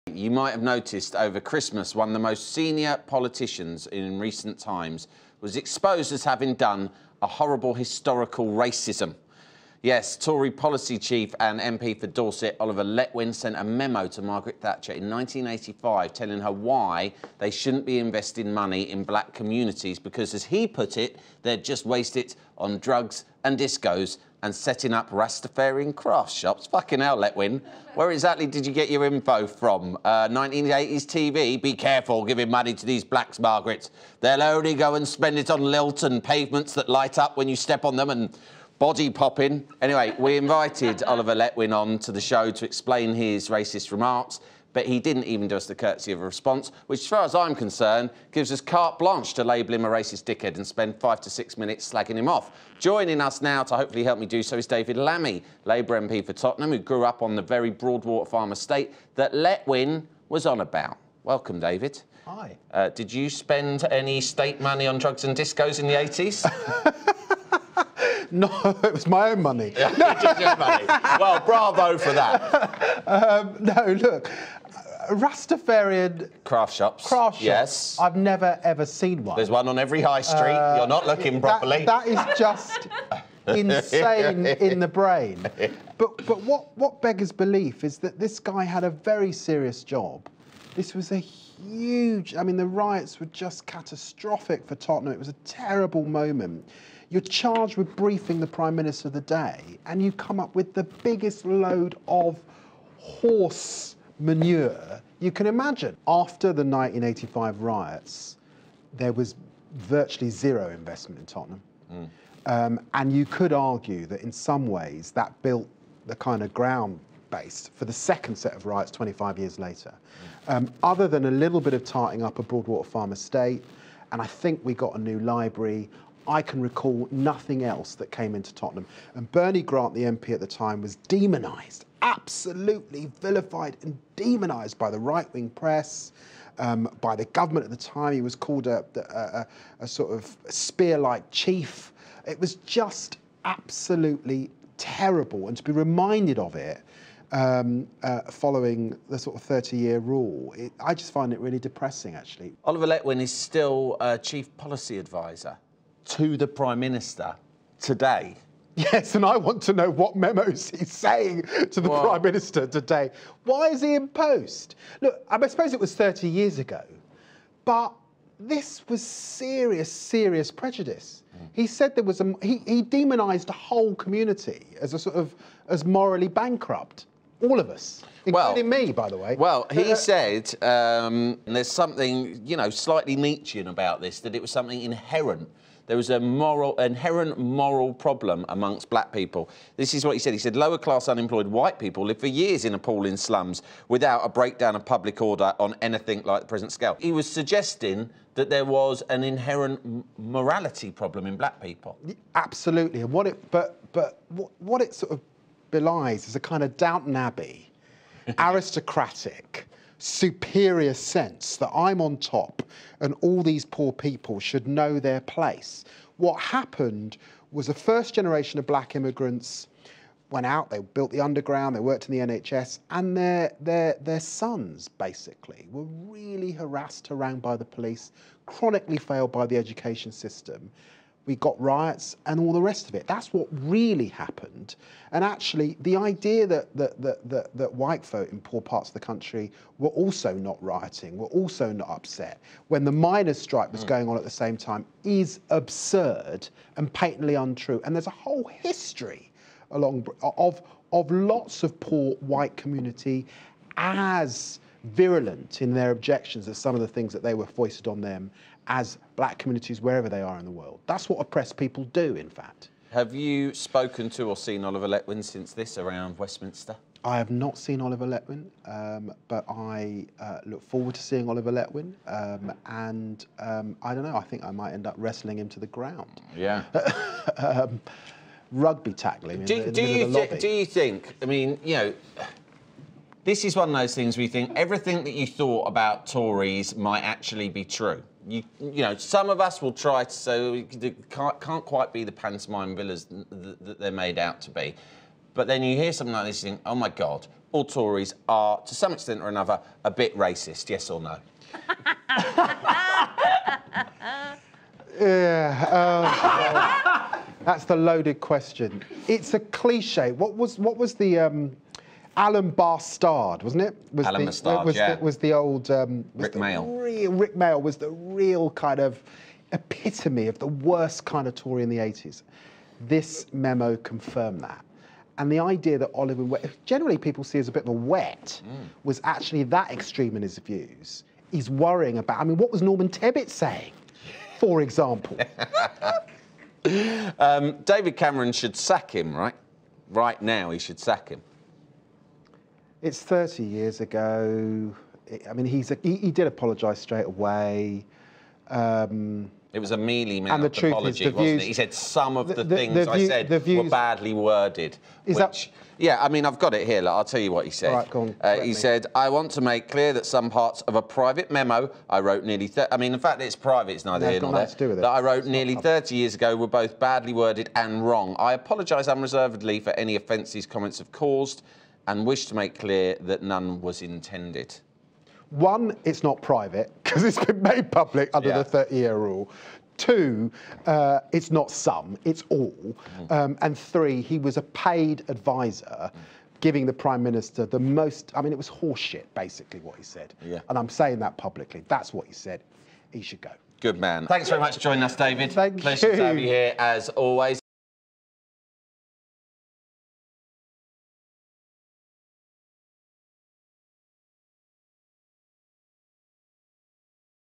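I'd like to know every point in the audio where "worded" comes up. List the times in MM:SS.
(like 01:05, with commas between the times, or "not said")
05:54, 06:07.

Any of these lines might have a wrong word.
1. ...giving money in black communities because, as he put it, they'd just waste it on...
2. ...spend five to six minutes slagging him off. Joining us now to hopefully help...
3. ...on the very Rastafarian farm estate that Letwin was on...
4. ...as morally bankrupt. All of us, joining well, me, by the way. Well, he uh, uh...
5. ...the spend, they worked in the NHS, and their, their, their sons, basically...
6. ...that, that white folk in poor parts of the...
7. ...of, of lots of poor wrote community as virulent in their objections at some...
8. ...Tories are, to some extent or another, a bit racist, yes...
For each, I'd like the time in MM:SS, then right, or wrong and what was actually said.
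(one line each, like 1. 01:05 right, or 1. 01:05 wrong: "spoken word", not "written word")
1. 00:17 wrong: "investing", not "giving"
2. 00:50 right
3. 00:57 wrong: "Broadwater", not "Rastafarian"
4. 02:55 wrong: "including", not "joining"
5. 03:41 wrong: "underground", not "spend"
6. 03:57 right
7. 04:10 wrong: "white", not "wrote"
8. 04:57 right.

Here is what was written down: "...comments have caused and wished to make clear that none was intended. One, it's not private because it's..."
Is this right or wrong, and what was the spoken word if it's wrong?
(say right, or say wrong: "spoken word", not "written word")
right.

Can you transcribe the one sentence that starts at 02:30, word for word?
It, I just find it really depressing, actually.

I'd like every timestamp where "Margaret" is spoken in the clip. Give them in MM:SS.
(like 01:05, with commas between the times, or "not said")
00:14, 00:33.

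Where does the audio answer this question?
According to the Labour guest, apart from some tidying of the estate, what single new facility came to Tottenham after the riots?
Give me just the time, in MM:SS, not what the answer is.
02:04.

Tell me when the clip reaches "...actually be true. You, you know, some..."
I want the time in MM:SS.
04:47.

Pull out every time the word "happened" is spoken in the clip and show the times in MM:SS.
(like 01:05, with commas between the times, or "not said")
03:36, 03:54.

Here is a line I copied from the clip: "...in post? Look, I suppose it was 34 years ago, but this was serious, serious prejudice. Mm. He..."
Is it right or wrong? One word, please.
wrong.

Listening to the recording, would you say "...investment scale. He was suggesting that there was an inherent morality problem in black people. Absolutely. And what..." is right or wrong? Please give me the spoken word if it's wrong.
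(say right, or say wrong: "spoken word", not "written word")
wrong: "present", not "investment".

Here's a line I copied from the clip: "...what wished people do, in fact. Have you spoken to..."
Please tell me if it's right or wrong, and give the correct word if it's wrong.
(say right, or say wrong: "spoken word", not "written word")
wrong: "oppressed", not "wished".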